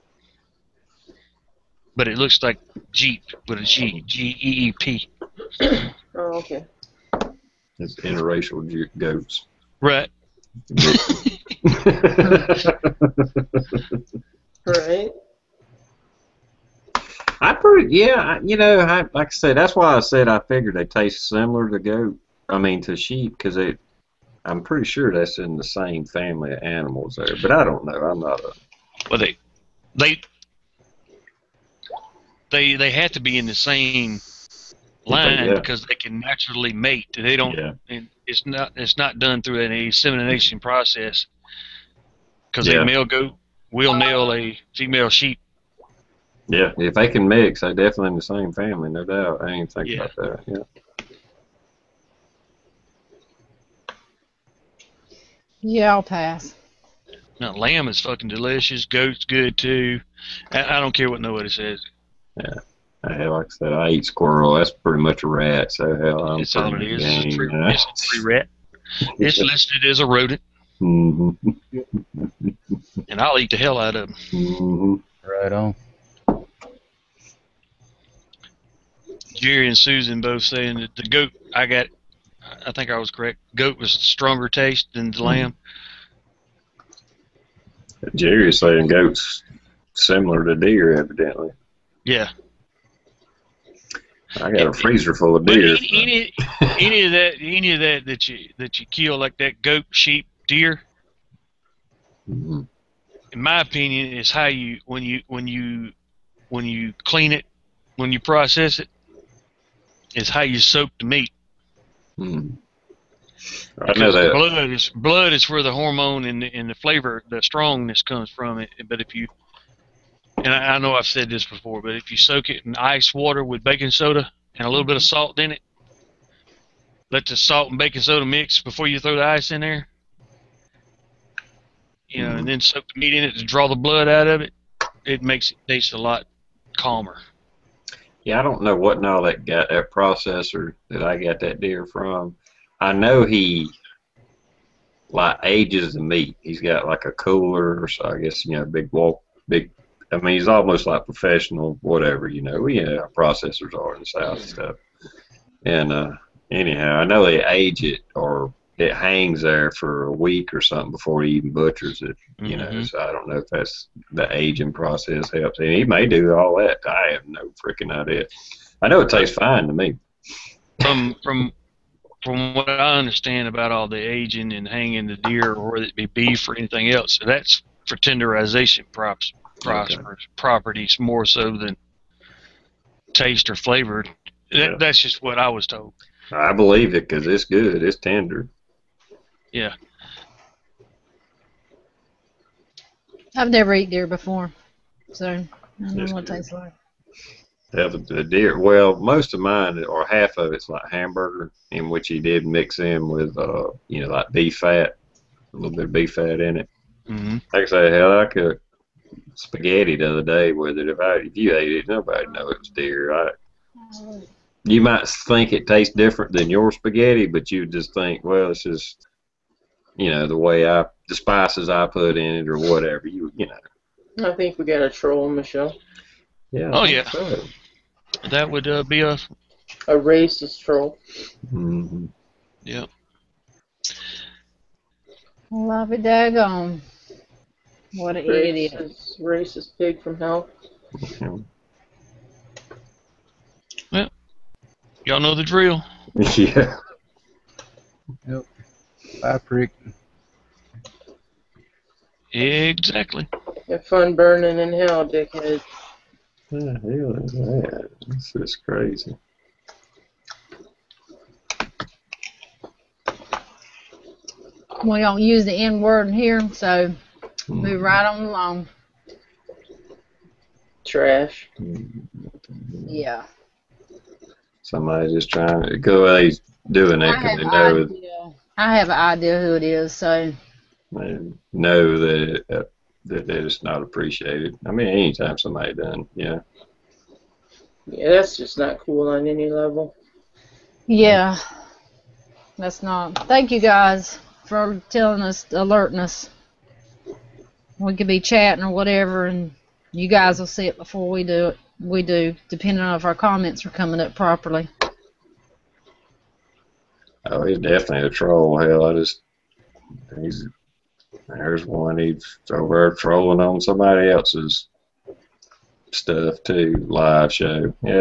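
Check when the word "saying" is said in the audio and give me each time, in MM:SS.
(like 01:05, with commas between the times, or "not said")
01:20, 01:28.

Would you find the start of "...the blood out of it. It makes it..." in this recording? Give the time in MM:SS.
02:13.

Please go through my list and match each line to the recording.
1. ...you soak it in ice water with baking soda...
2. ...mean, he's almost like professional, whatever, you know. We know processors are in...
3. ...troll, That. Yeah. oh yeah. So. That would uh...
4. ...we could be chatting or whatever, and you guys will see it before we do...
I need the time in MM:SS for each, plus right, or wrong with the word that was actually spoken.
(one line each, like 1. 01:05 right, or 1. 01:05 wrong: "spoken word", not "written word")
1. 02:02 right
2. 02:30 right
3. 03:44 wrong: "Michelle", not "That"
4. 04:57 right.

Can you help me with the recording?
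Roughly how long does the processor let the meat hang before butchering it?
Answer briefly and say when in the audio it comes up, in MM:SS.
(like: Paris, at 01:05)
a week, at 02:40.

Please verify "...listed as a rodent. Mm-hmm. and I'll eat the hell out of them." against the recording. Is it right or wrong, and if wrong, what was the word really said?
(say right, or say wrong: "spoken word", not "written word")
right.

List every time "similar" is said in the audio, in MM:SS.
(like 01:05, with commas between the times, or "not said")
00:21, 01:29.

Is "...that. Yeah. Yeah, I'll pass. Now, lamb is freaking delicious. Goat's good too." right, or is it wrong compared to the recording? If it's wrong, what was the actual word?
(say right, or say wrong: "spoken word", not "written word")
wrong: "fucking", not "freaking".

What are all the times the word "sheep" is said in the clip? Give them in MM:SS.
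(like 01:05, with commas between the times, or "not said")
00:22, 00:45, 01:39.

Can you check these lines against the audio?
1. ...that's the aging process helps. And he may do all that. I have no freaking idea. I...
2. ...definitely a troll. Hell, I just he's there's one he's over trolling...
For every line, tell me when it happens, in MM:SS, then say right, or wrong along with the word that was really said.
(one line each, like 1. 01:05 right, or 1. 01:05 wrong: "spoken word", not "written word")
1. 02:43 right
2. 05:07 right.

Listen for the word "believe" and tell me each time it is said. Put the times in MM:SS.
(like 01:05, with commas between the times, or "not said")
03:06.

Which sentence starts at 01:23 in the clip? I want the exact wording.
Goat was stronger taste than the lamb.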